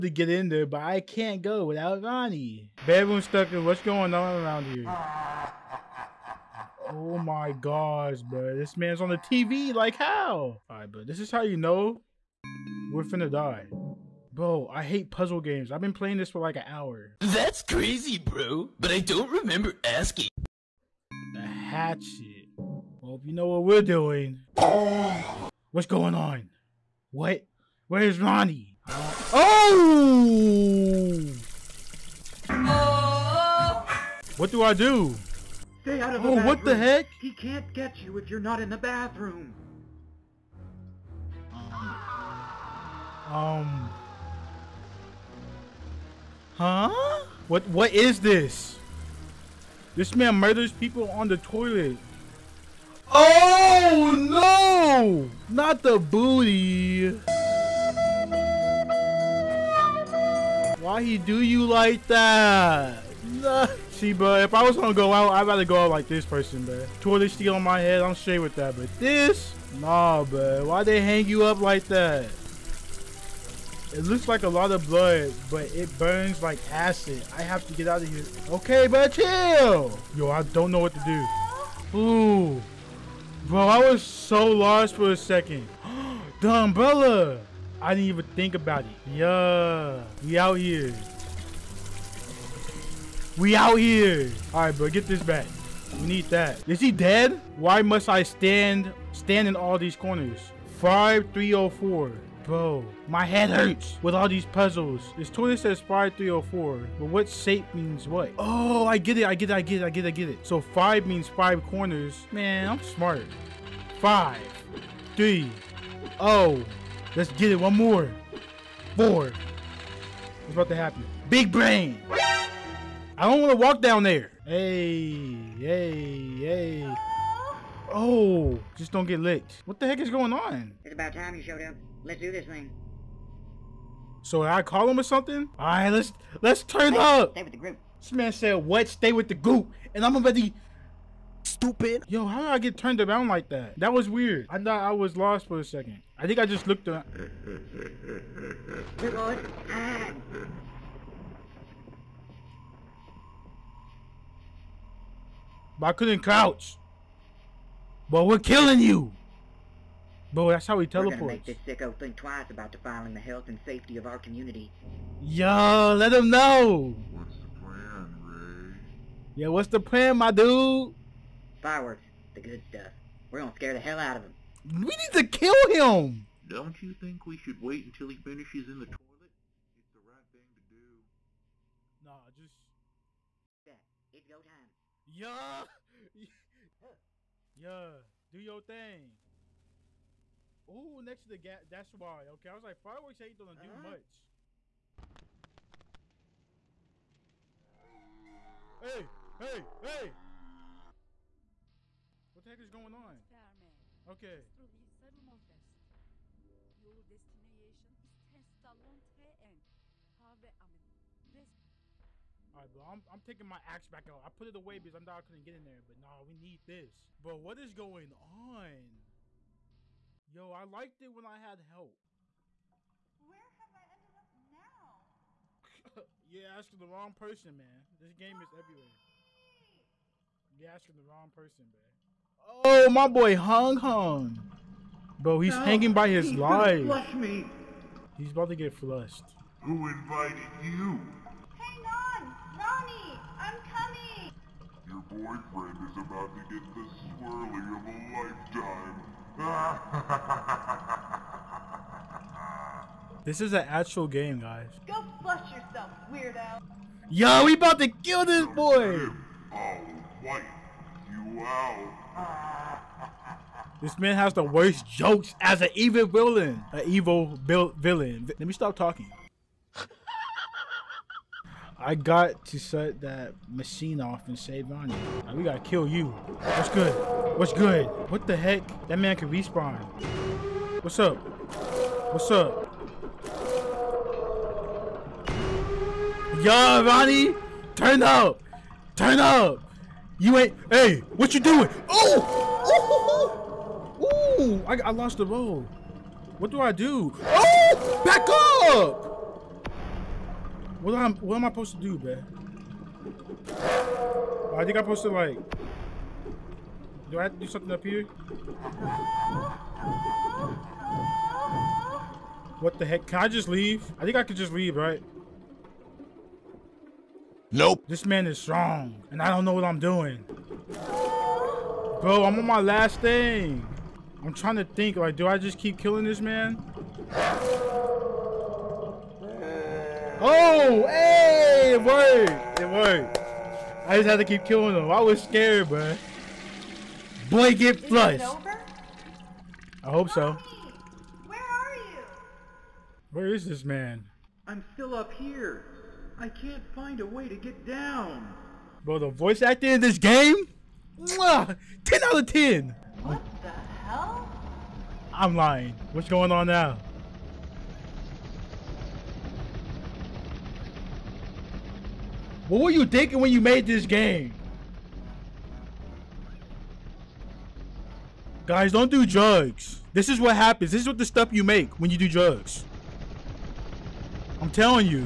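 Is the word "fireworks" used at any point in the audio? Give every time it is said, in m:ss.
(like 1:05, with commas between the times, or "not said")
2:51, 3:12.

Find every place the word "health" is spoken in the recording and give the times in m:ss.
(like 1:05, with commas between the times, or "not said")
2:43.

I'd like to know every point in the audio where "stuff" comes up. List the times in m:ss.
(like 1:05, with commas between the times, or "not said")
2:52, 6:11.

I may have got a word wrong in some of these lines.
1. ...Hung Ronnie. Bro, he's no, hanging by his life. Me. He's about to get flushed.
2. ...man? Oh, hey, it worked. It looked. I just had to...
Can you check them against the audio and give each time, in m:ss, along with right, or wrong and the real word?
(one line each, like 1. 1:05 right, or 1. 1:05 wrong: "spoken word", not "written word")
1. 3:53 wrong: "Hung", not "Ronnie"
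2. 5:26 wrong: "worked", not "looked".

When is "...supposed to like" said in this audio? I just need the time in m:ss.
5:04.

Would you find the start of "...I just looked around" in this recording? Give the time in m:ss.
2:26.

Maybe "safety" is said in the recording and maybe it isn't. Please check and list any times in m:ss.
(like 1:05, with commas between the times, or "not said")
2:43.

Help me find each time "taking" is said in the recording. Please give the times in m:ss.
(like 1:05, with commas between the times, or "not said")
3:33.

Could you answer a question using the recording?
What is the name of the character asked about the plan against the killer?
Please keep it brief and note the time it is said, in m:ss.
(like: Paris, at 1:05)
Ray, at 2:48.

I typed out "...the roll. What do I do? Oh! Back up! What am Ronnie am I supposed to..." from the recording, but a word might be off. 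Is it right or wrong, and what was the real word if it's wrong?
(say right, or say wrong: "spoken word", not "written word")
wrong: "What", not "Ronnie".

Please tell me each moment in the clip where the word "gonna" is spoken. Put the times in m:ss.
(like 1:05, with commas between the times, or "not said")
1:04, 2:40, 2:53, 3:13.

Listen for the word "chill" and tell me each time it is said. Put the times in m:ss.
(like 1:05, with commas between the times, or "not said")
1:19.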